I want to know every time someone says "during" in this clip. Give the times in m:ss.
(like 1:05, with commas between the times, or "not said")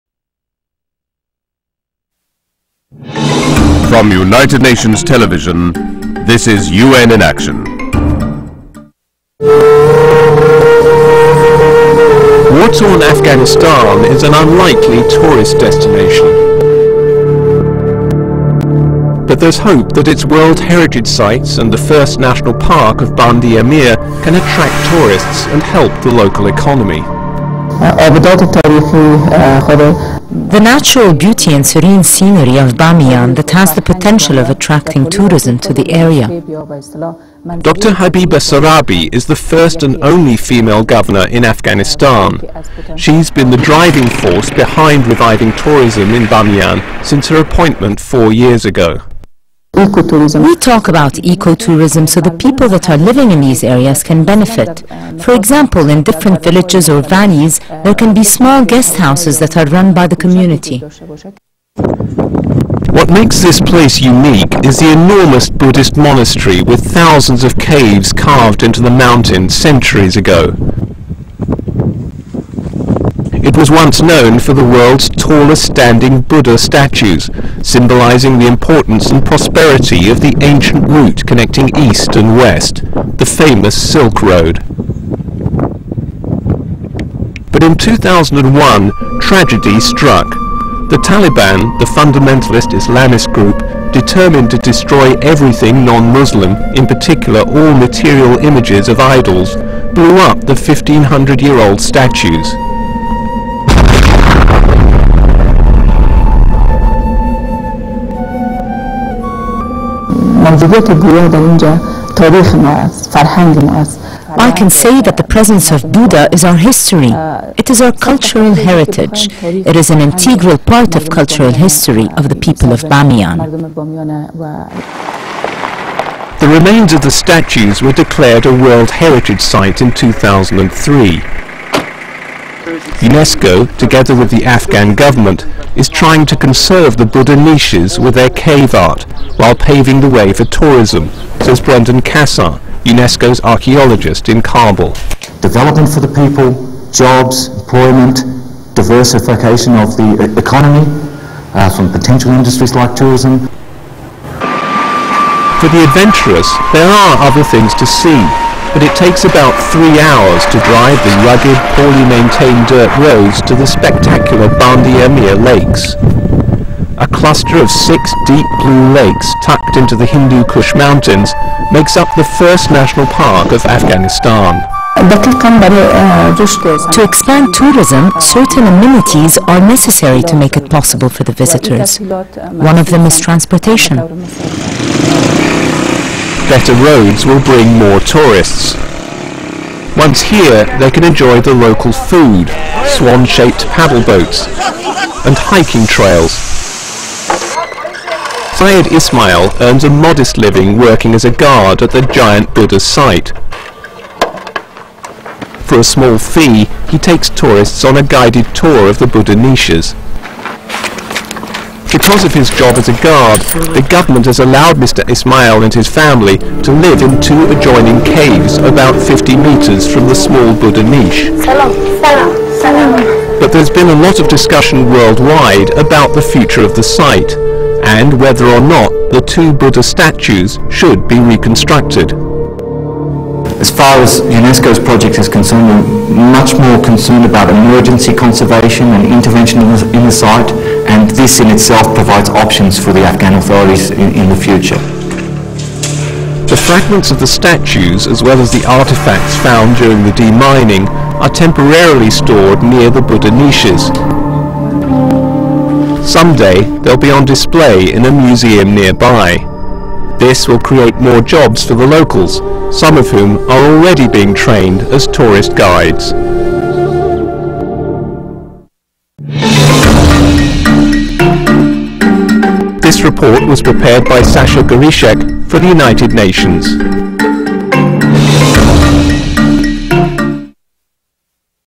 4:09.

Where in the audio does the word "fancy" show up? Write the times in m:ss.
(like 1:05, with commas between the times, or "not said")
not said.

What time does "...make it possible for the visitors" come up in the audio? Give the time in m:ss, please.
3:00.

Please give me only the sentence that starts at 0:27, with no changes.
Uh, of uh, The natural beauty and serene scenery of Bamiyan that has the potential of attracting tourism to the area.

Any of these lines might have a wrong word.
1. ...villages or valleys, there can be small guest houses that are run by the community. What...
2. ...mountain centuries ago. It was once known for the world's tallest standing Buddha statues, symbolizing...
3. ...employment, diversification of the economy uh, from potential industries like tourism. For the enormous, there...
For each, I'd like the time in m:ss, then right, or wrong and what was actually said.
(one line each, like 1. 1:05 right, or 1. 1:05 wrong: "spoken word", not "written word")
1. 0:56 right
2. 1:08 right
3. 2:27 wrong: "adventurous", not "enormous".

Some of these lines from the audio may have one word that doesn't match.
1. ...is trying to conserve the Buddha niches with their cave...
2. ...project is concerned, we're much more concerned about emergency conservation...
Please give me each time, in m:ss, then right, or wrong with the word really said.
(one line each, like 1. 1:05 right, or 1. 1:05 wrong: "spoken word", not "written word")
1. 2:15 right
2. 3:54 right.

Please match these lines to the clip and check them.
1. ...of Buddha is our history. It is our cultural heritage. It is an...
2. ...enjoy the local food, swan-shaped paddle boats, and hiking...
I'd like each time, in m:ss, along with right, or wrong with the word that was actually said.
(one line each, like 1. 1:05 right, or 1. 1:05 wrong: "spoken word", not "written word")
1. 1:55 right
2. 3:11 right.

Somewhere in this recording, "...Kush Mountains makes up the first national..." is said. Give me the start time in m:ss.
2:50.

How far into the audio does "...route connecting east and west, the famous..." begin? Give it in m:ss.
1:20.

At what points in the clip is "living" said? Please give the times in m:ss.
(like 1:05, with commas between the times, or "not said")
0:52, 3:20.